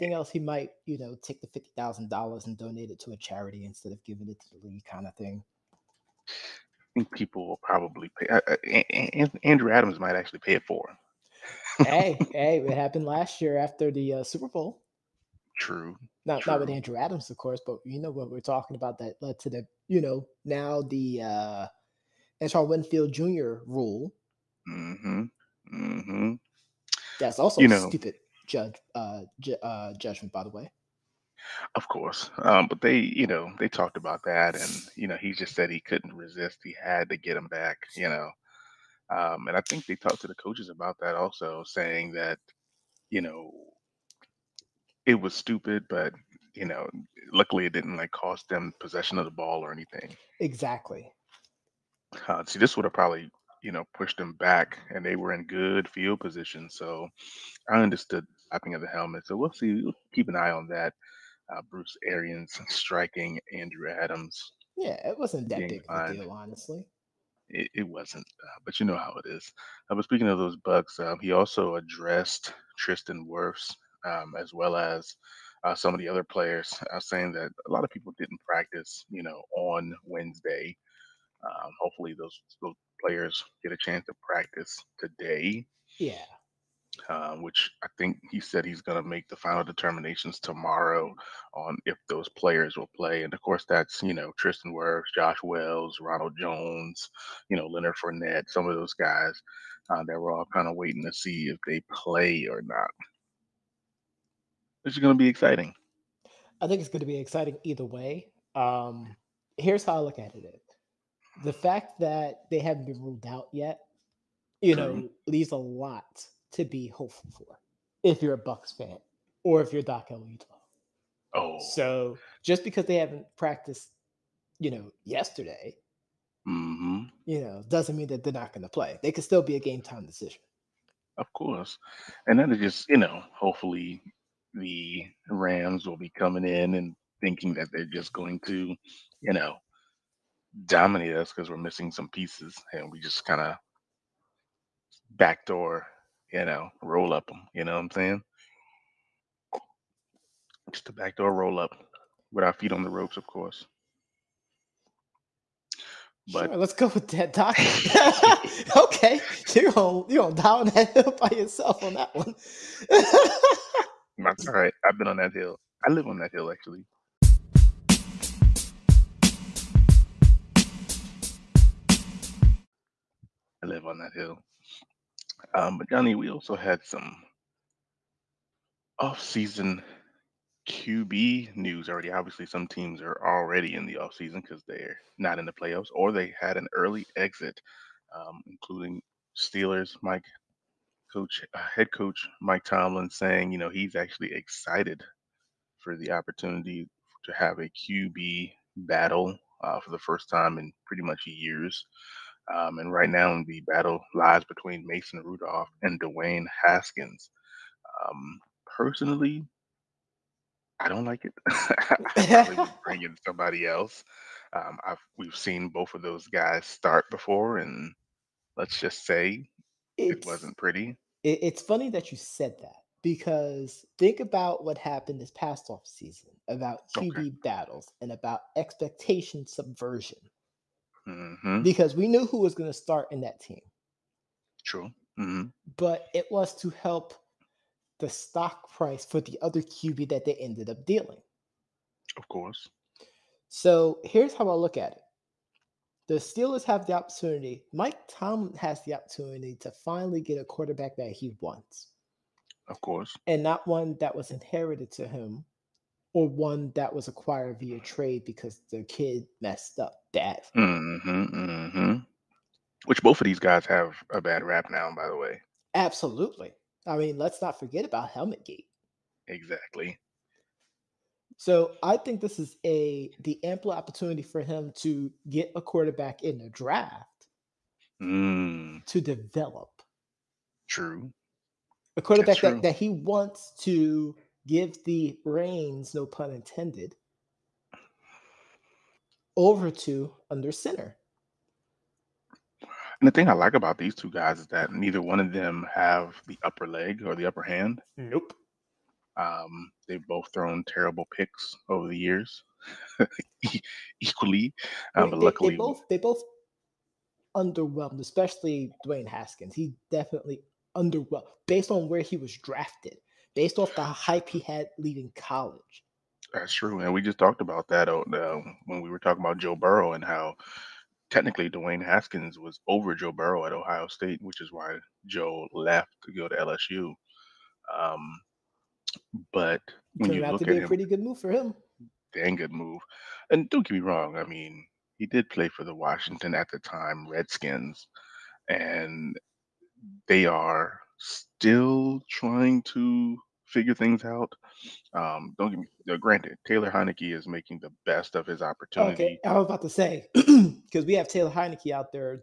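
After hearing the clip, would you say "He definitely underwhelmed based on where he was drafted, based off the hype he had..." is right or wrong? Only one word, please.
right.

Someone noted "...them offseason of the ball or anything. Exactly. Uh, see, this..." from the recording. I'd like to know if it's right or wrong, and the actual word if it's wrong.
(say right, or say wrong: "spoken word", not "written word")
wrong: "possession", not "offseason".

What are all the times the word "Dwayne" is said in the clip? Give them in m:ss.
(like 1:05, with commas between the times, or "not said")
3:26, 5:08, 5:21.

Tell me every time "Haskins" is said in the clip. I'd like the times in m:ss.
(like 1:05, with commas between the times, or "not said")
3:26, 5:09, 5:21.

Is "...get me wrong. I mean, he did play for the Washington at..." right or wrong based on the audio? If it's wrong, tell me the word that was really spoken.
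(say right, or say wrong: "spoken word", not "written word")
right.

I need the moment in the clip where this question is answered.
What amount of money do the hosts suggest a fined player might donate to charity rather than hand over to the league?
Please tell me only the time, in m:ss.
0:01.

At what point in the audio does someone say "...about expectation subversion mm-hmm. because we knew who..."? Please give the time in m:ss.
3:48.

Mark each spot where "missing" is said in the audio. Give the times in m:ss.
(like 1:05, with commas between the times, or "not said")
2:21.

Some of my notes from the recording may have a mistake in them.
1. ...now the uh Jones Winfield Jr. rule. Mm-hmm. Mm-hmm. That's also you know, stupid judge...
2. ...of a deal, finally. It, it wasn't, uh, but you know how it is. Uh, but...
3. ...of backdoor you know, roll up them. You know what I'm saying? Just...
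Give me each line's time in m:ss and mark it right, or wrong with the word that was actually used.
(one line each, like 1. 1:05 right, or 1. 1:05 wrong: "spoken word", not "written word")
1. 0:20 wrong: "Antoine", not "Jones"
2. 1:05 wrong: "honestly", not "finally"
3. 2:23 right.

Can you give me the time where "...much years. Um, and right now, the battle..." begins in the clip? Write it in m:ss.
3:21.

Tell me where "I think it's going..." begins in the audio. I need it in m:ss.
1:46.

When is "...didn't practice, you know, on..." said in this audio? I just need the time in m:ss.
1:18.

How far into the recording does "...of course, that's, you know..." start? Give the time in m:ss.
1:33.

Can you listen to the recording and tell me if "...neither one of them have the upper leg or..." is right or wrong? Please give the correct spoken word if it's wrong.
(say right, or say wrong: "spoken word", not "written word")
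right.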